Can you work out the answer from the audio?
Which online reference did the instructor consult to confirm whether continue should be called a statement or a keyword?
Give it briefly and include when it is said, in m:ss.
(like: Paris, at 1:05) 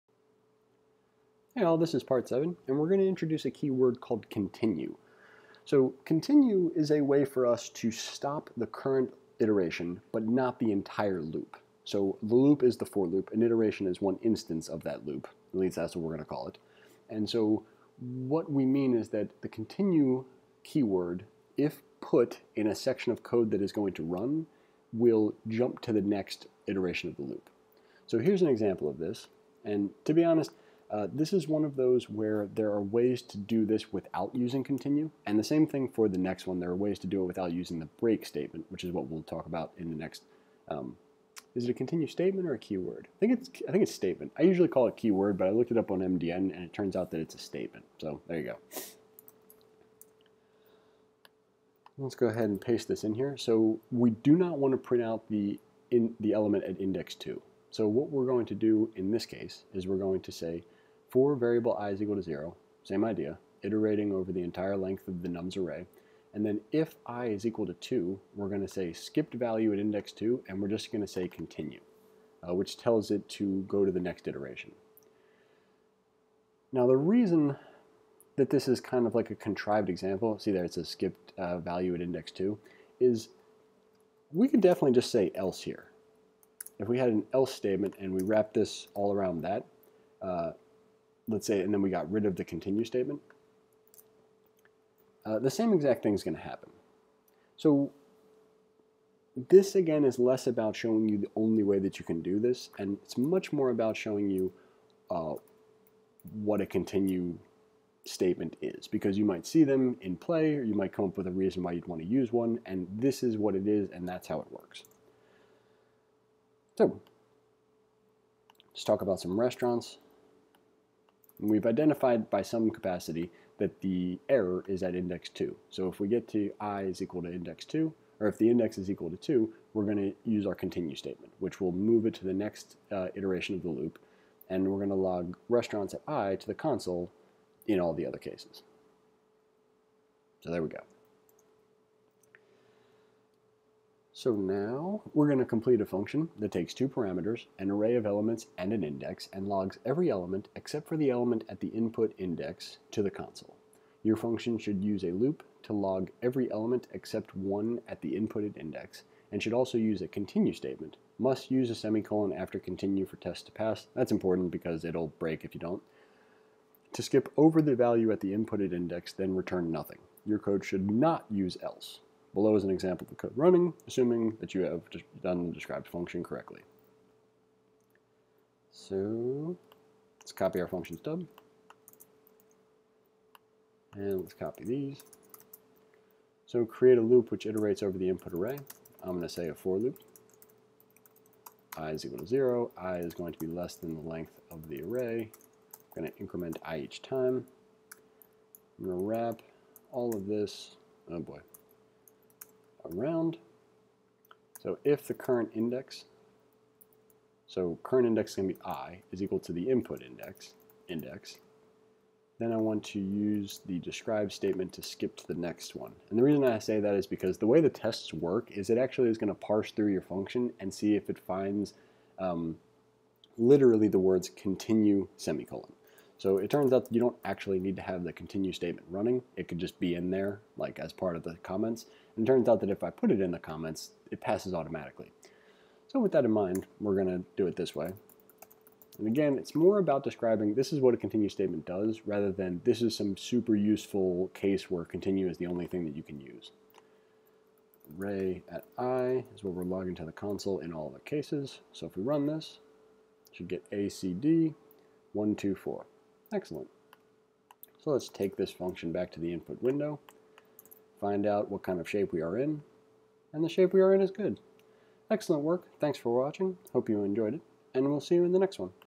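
MDN, at 0:45.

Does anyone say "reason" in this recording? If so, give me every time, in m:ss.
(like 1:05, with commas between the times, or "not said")
1:16, 1:51, 3:36.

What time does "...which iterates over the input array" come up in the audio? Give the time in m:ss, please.
3:07.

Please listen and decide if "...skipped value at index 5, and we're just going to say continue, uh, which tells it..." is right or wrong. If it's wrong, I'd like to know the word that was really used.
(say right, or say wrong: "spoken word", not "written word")
wrong: "2", not "5".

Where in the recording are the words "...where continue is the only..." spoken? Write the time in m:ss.
4:04.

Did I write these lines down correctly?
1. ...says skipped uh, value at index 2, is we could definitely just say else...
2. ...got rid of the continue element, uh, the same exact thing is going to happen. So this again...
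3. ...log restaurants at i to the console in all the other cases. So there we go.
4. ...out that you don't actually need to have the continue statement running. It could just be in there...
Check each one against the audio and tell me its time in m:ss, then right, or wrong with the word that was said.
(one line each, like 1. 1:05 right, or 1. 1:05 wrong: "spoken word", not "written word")
1. 1:20 right
2. 1:31 wrong: "statement", not "element"
3. 2:14 right
4. 3:46 right.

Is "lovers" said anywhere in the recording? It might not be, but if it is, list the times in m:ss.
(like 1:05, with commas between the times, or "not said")
not said.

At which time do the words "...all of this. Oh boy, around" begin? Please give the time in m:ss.
3:19.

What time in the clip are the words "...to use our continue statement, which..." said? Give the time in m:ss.
2:09.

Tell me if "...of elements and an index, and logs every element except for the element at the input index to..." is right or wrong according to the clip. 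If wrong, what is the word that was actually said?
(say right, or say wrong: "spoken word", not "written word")
right.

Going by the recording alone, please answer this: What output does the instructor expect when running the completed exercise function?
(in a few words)
acd124.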